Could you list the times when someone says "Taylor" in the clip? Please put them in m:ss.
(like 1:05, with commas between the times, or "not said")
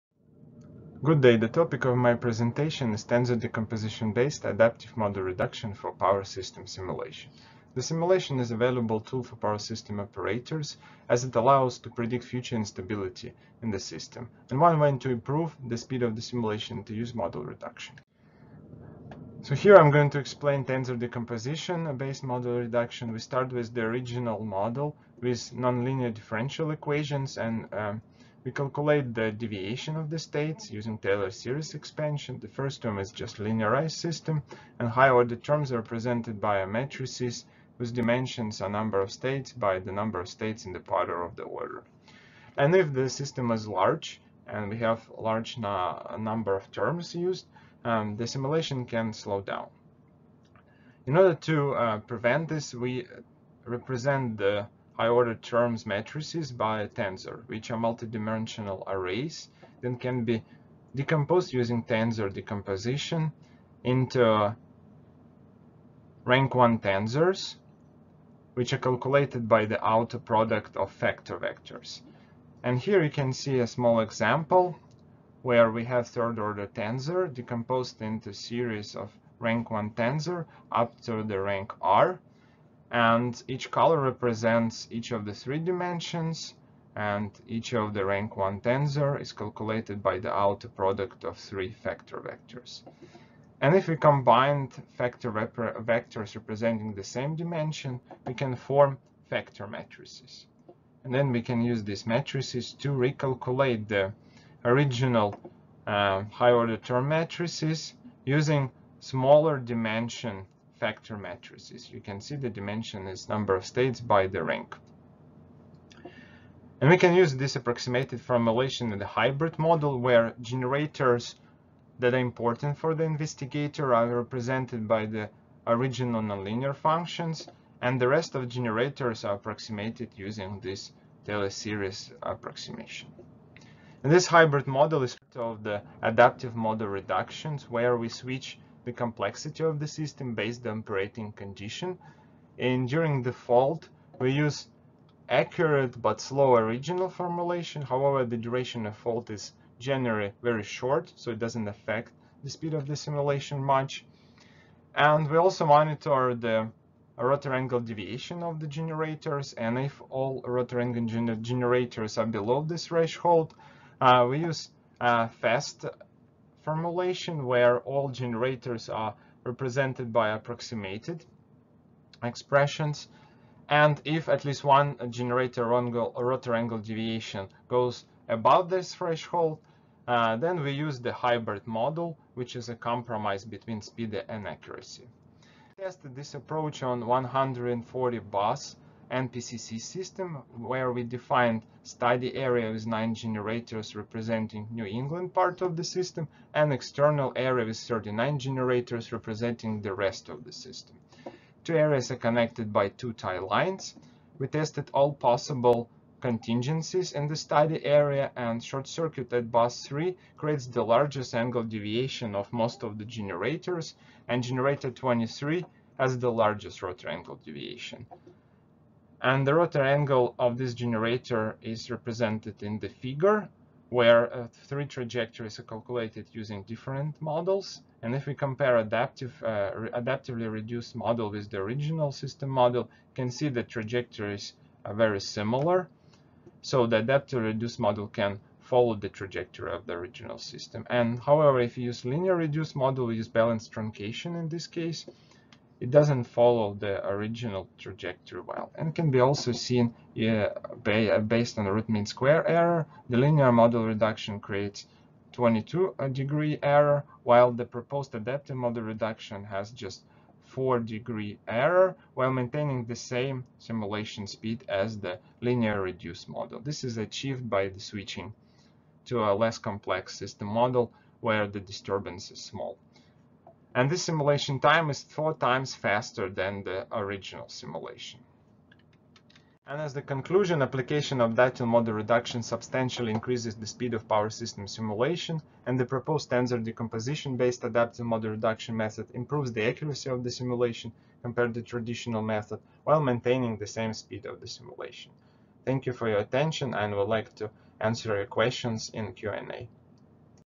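0:30, 2:11.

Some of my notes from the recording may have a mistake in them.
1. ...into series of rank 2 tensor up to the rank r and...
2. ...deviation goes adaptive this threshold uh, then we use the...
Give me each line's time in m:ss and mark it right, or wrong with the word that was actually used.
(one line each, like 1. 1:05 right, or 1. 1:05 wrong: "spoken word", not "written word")
1. 1:18 wrong: "1", not "2"
2. 2:56 wrong: "above", not "adaptive".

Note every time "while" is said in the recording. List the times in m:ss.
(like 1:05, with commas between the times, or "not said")
4:17, 4:22, 4:52.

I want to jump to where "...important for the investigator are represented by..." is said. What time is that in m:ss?
2:02.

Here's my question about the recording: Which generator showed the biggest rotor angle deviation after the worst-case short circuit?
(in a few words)
Generator 23.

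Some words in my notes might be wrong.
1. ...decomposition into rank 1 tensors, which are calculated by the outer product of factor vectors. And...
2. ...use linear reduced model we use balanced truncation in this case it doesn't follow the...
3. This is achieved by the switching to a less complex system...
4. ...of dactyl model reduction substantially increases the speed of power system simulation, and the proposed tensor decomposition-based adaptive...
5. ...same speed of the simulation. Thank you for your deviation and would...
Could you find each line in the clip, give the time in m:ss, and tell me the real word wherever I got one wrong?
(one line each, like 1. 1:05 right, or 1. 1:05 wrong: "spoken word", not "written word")
1. 1:02 right
2. 4:01 right
3. 4:26 right
4. 4:41 right
5. 4:53 wrong: "attention", not "deviation".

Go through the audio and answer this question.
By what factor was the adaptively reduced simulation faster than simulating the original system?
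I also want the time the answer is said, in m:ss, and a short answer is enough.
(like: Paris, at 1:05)
4 times, at 4:35.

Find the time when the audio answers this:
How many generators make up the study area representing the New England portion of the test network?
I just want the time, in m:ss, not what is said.
3:12.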